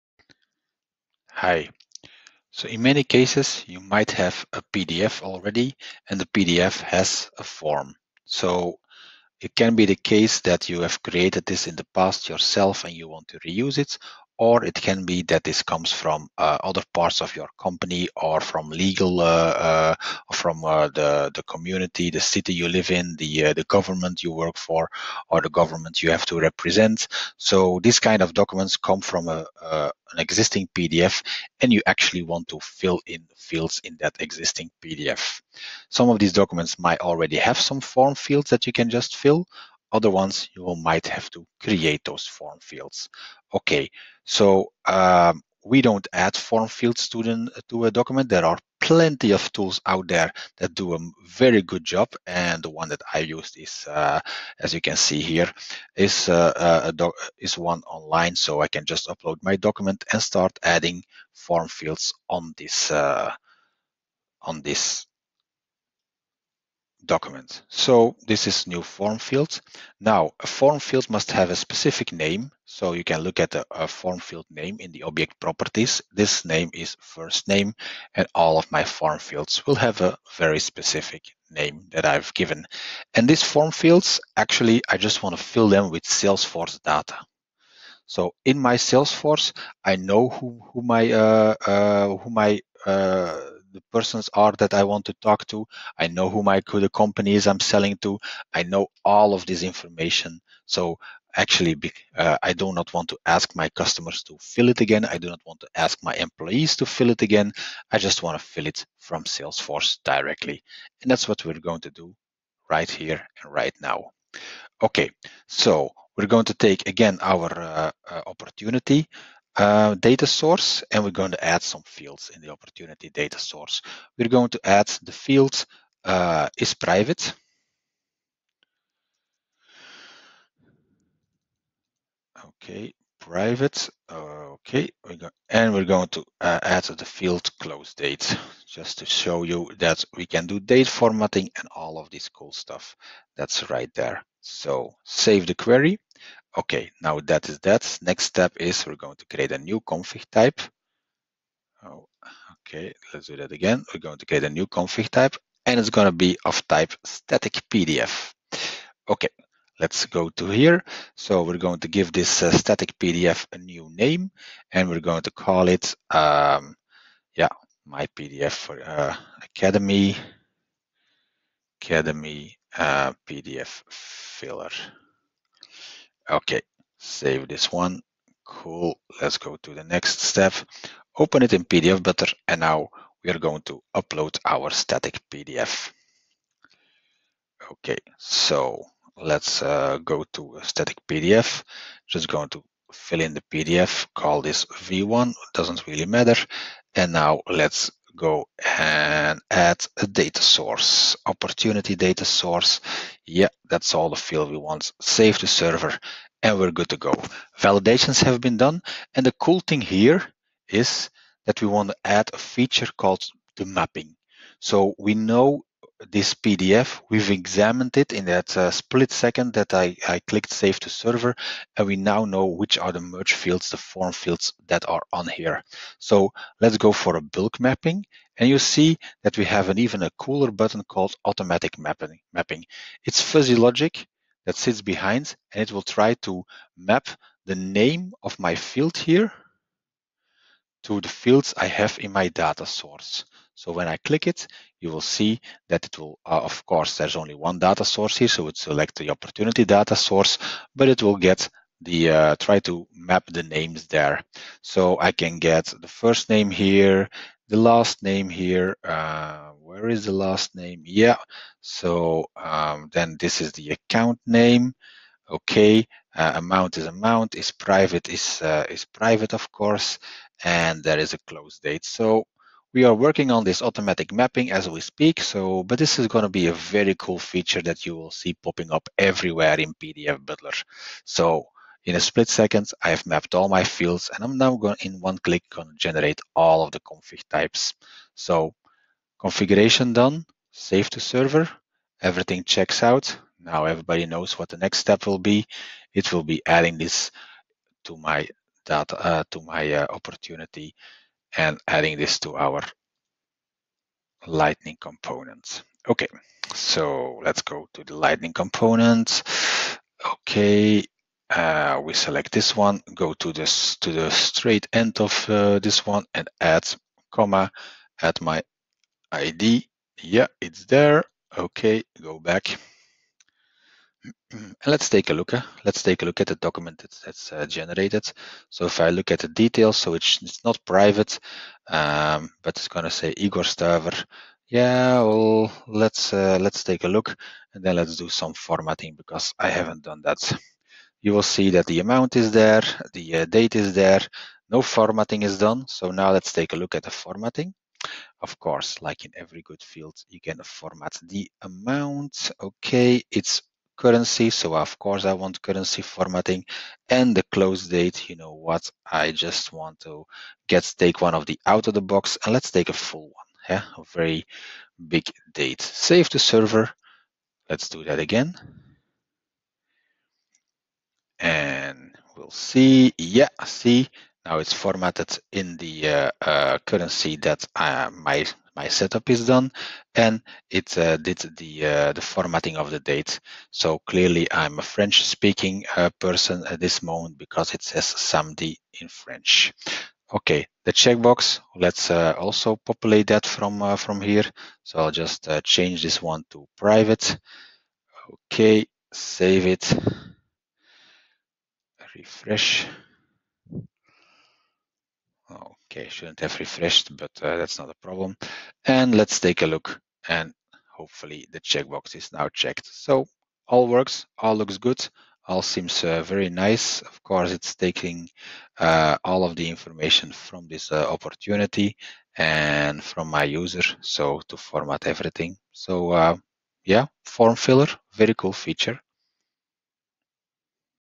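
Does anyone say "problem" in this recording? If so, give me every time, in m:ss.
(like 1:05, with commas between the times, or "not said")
6:47.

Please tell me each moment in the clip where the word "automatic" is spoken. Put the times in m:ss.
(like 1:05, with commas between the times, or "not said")
3:51, 4:33.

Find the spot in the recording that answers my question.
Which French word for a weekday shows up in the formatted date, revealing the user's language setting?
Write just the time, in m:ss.
6:27.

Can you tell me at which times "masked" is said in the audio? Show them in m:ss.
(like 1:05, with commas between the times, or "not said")
not said.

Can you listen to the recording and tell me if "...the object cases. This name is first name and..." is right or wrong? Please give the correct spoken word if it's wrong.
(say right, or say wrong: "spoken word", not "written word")
wrong: "properties", not "cases".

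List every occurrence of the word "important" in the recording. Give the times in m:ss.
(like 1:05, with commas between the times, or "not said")
not said.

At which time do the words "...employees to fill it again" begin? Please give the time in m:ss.
1:46.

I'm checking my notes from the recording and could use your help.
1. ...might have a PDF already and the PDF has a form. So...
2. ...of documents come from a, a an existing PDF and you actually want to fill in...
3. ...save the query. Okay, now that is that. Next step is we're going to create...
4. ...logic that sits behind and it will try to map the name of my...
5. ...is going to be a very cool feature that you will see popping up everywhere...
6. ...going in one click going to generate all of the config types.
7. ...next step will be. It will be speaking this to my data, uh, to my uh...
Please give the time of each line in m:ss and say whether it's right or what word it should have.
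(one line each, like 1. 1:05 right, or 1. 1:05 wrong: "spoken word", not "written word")
1. 0:03 right
2. 0:28 right
3. 2:25 right
4. 3:53 right
5. 4:35 right
6. 4:44 right
7. 4:54 wrong: "adding", not "speaking".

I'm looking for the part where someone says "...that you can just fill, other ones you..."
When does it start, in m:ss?
0:38.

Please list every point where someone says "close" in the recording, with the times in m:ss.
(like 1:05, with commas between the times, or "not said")
2:17, 4:31, 5:57.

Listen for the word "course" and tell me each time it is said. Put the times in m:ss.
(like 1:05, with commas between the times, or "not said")
4:06, 4:29, 5:48, 5:54, 6:57.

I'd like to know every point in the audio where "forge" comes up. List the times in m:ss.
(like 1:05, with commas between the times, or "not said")
not said.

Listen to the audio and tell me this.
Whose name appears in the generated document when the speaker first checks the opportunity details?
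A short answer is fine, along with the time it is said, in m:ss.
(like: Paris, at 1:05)
Igor Staver, at 5:33.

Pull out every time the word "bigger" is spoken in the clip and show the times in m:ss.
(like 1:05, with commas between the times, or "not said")
not said.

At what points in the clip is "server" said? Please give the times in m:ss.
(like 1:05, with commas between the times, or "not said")
3:25, 3:40, 4:51, 6:06.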